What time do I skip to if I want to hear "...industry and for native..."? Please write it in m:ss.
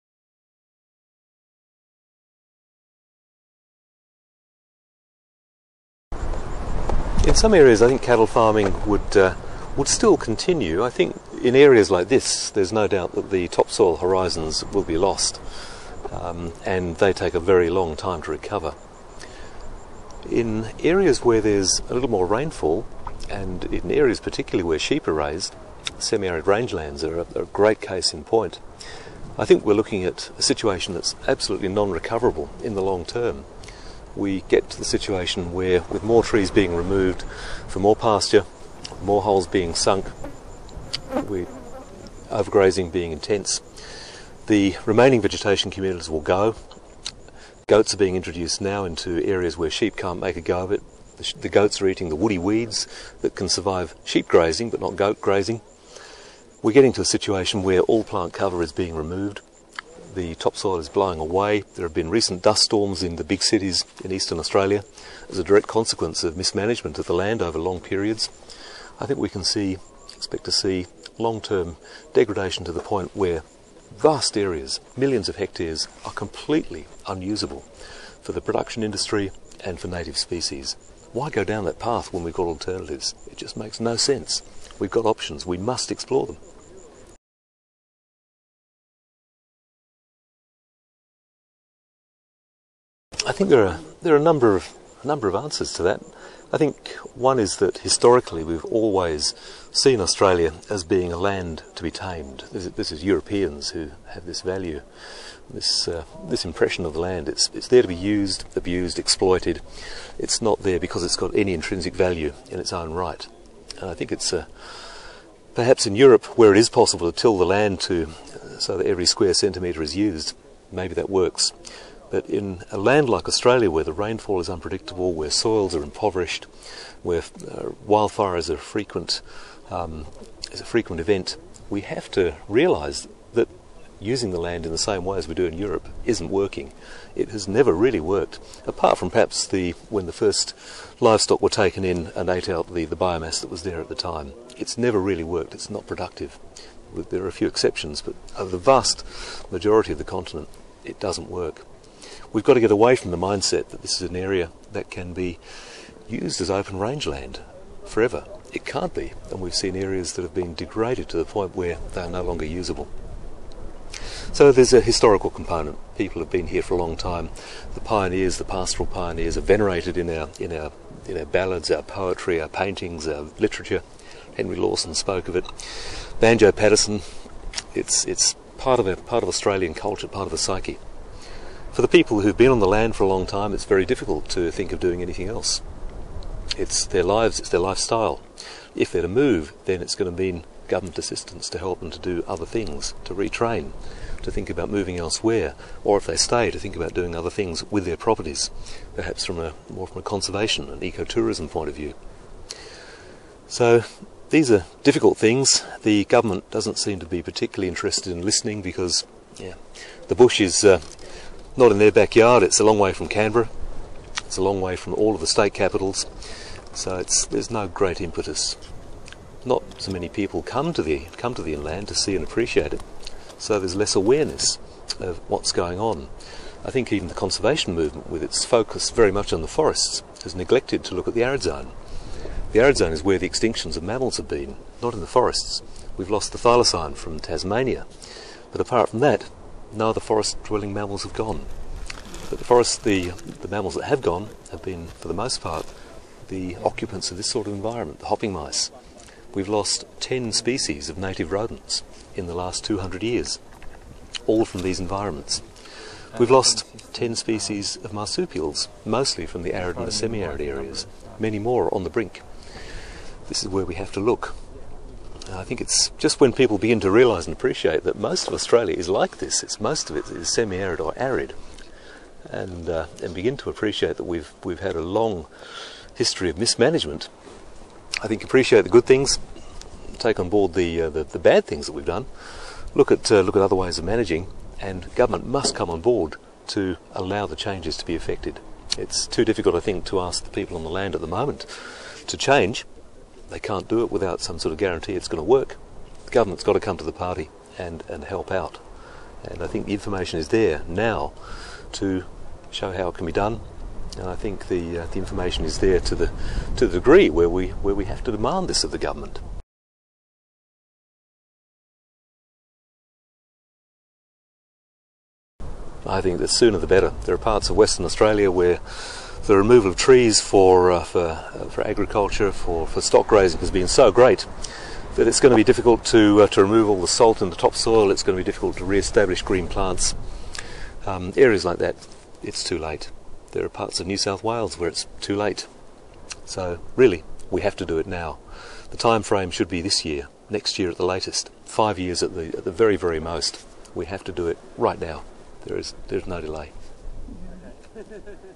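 1:18.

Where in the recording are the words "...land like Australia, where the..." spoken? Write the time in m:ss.
2:02.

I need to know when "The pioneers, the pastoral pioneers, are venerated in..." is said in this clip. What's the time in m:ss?
2:47.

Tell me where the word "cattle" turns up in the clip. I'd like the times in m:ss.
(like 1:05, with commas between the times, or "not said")
0:08.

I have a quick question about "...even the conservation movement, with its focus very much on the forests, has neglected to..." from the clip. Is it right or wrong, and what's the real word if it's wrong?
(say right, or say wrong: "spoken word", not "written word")
right.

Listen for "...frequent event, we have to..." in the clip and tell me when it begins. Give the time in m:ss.
2:10.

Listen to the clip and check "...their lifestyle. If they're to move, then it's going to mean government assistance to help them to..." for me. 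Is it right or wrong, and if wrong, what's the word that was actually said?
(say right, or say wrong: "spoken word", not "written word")
right.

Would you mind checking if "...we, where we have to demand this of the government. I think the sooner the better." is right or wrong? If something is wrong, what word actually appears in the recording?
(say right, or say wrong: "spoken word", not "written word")
right.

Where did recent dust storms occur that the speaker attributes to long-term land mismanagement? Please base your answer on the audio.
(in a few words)
Eastern Australia.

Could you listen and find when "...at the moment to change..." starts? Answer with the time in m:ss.
4:50.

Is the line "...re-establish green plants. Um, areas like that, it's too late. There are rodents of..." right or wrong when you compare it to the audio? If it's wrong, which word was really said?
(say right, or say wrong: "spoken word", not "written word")
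wrong: "parts", not "rodents".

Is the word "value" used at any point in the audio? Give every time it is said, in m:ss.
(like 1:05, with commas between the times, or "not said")
1:44, 1:51.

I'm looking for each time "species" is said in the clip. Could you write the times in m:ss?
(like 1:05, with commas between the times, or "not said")
1:20, 4:10, 4:17.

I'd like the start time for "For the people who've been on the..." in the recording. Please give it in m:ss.
3:01.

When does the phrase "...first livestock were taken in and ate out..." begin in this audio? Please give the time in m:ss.
2:20.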